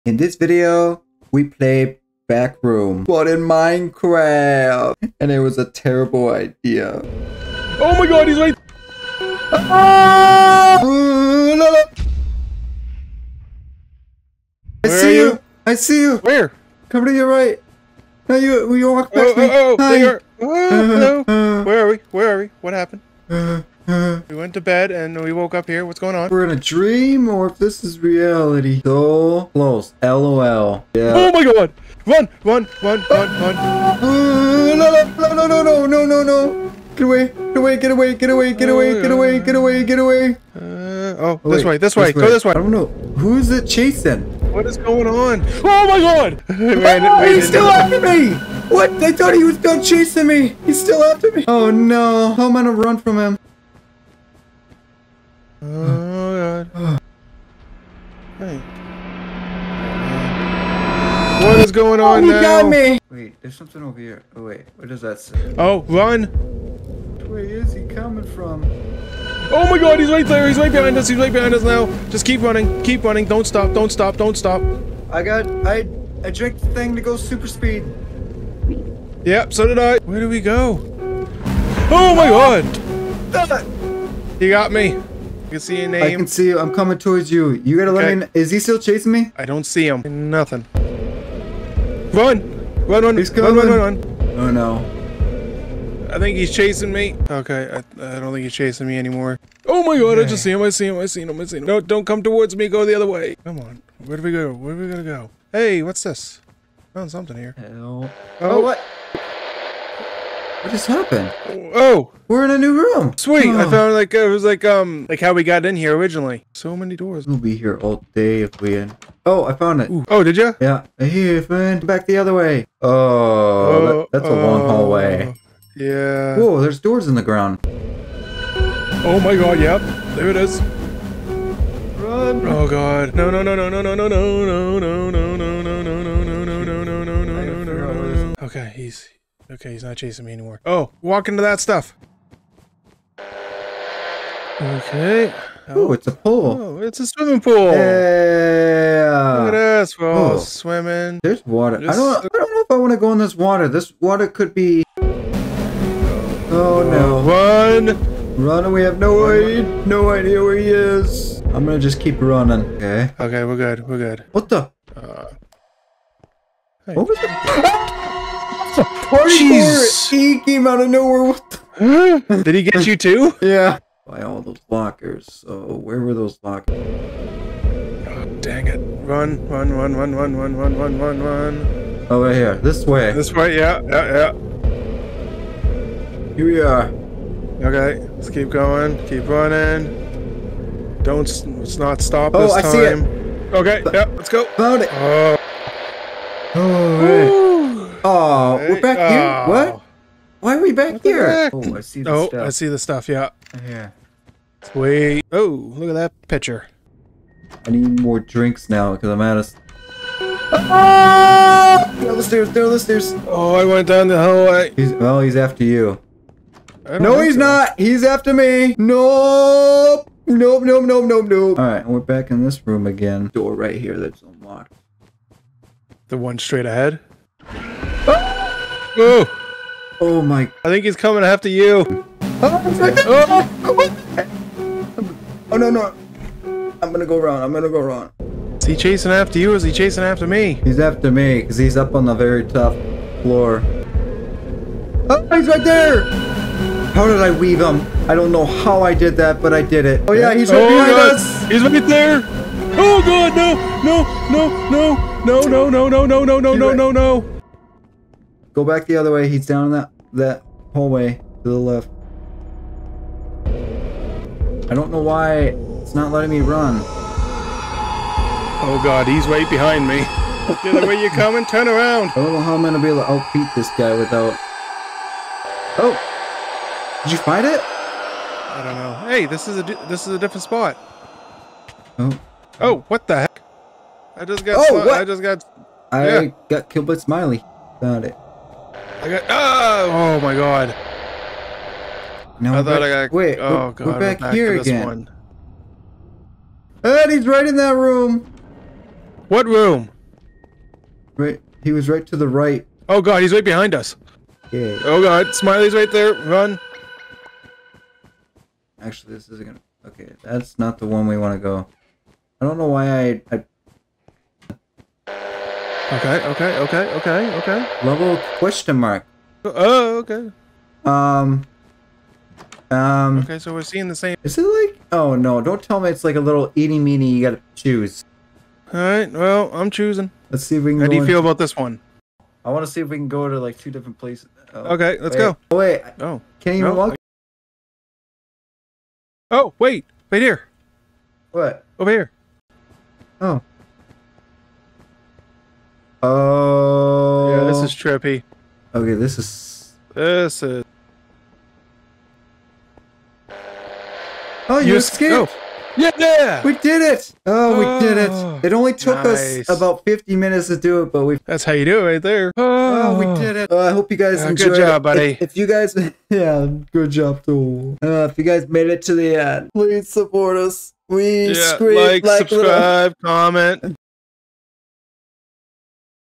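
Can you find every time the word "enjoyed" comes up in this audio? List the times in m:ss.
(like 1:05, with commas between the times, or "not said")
6:04.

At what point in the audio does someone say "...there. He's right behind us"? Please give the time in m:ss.
1:10.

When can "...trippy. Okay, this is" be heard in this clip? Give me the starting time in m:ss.
5:47.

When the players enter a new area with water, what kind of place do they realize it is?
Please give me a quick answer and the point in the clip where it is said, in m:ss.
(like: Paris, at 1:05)
A swimming pool, at 2:27.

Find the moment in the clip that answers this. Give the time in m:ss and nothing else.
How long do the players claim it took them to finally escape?
5:59.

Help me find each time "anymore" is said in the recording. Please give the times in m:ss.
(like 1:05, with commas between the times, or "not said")
1:38, 2:20.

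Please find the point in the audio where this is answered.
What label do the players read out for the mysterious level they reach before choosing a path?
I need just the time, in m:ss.
5:17.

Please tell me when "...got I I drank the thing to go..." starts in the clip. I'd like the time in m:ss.
1:15.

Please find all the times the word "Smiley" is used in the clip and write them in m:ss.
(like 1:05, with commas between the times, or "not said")
4:46, 5:05.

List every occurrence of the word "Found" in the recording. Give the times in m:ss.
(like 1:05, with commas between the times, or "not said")
1:46, 3:14, 4:47.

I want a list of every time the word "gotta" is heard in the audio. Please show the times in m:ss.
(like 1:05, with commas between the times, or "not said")
1:27, 5:27.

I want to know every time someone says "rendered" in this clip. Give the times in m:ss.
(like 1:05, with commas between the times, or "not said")
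not said.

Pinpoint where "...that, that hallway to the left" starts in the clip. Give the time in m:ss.
4:19.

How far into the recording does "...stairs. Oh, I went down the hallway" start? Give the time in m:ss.
3:32.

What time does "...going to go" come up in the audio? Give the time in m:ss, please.
1:44.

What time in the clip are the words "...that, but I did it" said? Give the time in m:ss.
4:09.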